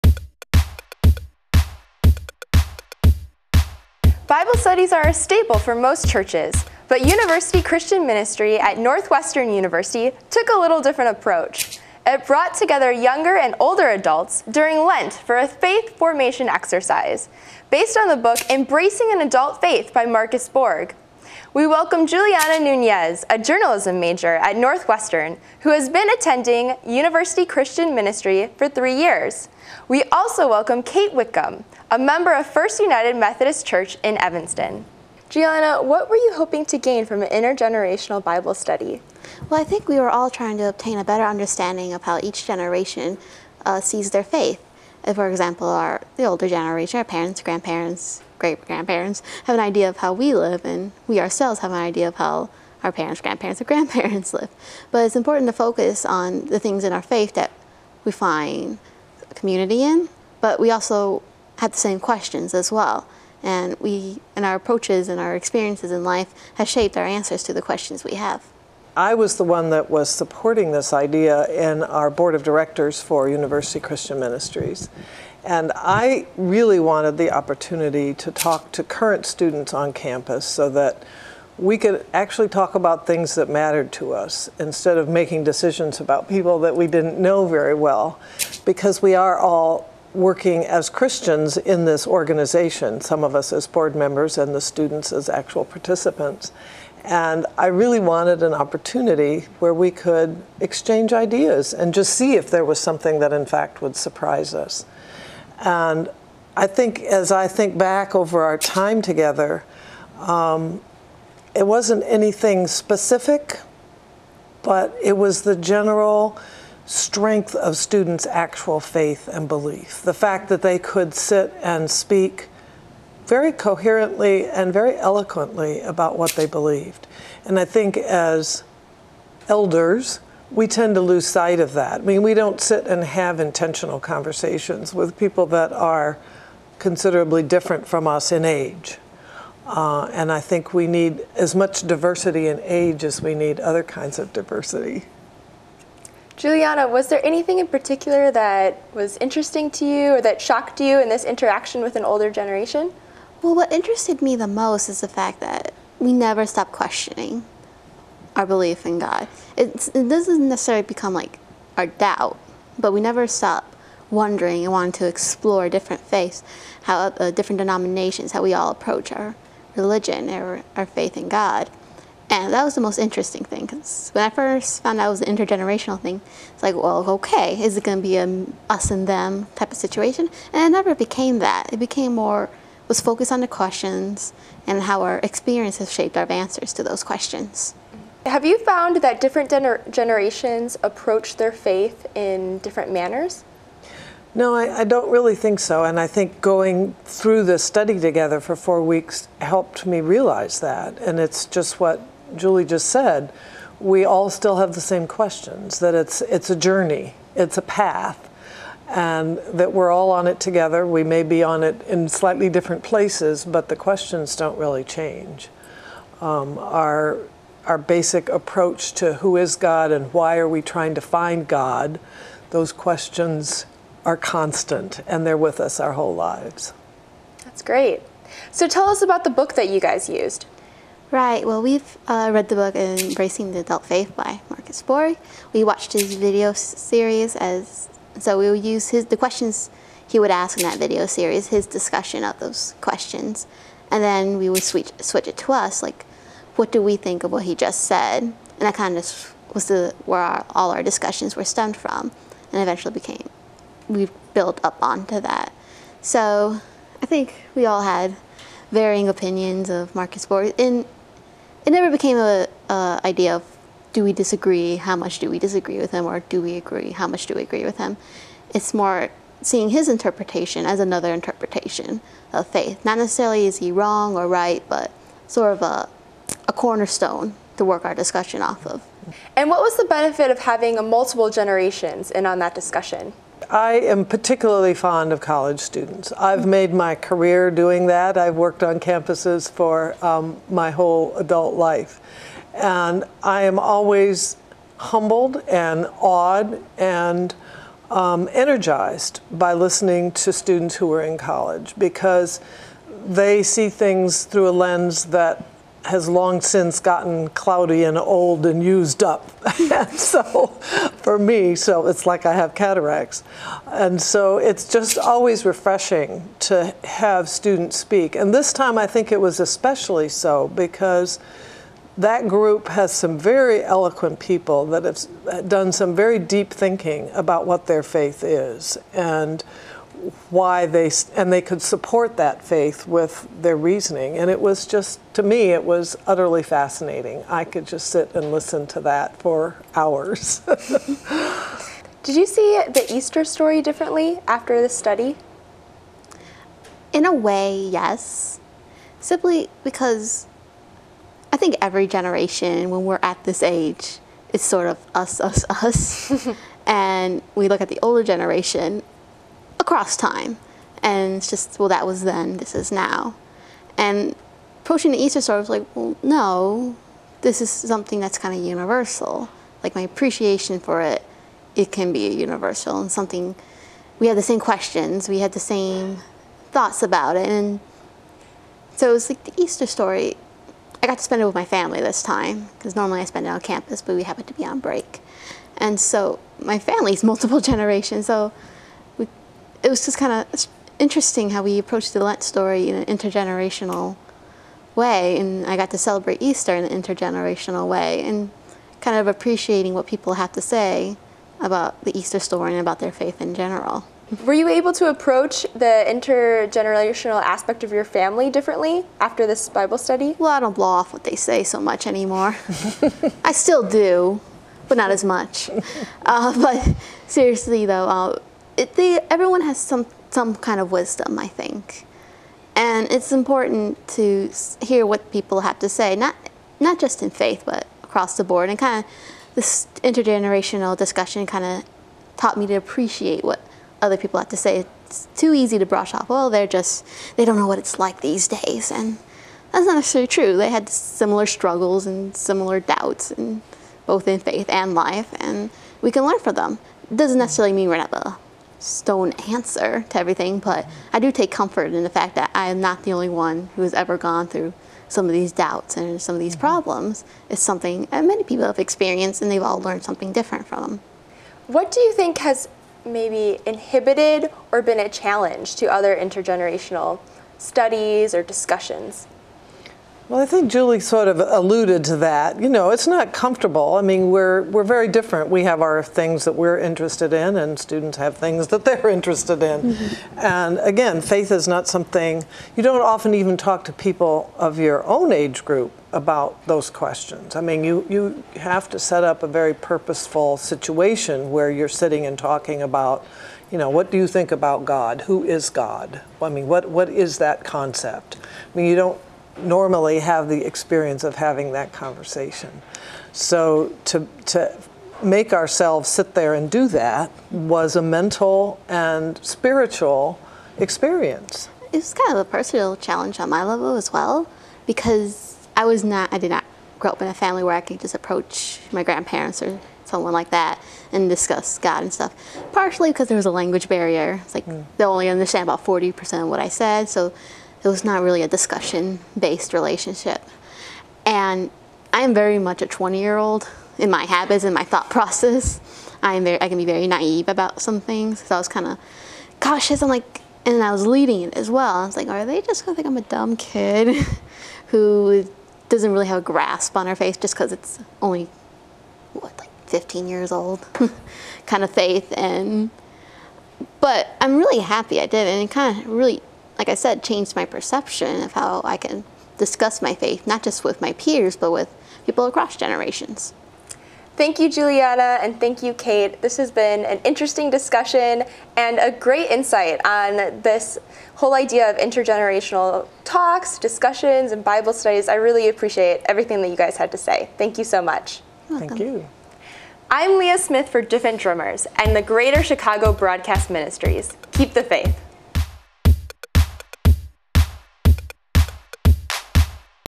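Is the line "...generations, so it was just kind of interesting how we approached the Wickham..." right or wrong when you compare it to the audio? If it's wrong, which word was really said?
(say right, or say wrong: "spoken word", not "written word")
wrong: "Lent", not "Wickham".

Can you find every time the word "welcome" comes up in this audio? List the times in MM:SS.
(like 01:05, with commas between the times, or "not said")
00:21, 00:30.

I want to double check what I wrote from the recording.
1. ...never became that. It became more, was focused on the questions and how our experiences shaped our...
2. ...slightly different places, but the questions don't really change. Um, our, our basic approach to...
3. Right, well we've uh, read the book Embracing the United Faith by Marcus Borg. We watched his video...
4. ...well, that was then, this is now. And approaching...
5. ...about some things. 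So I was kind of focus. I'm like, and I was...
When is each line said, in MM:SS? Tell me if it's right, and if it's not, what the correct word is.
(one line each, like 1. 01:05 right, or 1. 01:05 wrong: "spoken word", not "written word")
1. 03:00 right
2. 03:32 right
3. 03:51 wrong: "Adult", not "United"
4. 06:01 right
5. 08:57 wrong: "cautious", not "focus".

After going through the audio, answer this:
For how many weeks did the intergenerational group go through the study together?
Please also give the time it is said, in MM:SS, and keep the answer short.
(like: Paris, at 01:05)
4, at 03:18.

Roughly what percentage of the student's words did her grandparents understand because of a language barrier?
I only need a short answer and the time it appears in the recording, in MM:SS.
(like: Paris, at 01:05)
40%, at 08:45.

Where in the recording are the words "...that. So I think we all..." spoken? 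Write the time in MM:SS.
04:15.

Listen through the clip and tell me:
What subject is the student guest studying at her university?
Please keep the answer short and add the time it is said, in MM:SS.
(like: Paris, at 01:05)
Journalism, at 00:23.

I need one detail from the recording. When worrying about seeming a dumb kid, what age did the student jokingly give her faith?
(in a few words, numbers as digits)
15.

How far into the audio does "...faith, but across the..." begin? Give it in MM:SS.
07:07.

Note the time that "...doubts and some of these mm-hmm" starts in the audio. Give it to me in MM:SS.
07:35.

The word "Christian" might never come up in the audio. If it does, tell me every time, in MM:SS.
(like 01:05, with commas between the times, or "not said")
00:07, 00:27, 01:13, 01:30.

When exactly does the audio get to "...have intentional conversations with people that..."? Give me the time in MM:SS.
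02:13.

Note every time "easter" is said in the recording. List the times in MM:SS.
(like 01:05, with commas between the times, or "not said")
05:42, 06:04, 06:19, 06:36, 06:41.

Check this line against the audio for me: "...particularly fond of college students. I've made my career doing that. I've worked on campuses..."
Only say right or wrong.
right.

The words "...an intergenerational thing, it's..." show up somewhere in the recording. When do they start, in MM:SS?
02:55.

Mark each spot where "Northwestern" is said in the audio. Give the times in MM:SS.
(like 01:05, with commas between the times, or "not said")
00:08, 00:24.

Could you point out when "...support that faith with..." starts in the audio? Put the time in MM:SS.
05:31.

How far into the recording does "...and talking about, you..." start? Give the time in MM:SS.
08:12.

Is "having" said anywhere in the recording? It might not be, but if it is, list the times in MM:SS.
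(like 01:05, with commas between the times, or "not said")
04:40, 08:21.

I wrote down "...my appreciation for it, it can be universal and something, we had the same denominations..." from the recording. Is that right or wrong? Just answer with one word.
wrong.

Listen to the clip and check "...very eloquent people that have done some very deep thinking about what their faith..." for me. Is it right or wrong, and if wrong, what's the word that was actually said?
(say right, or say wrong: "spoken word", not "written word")
right.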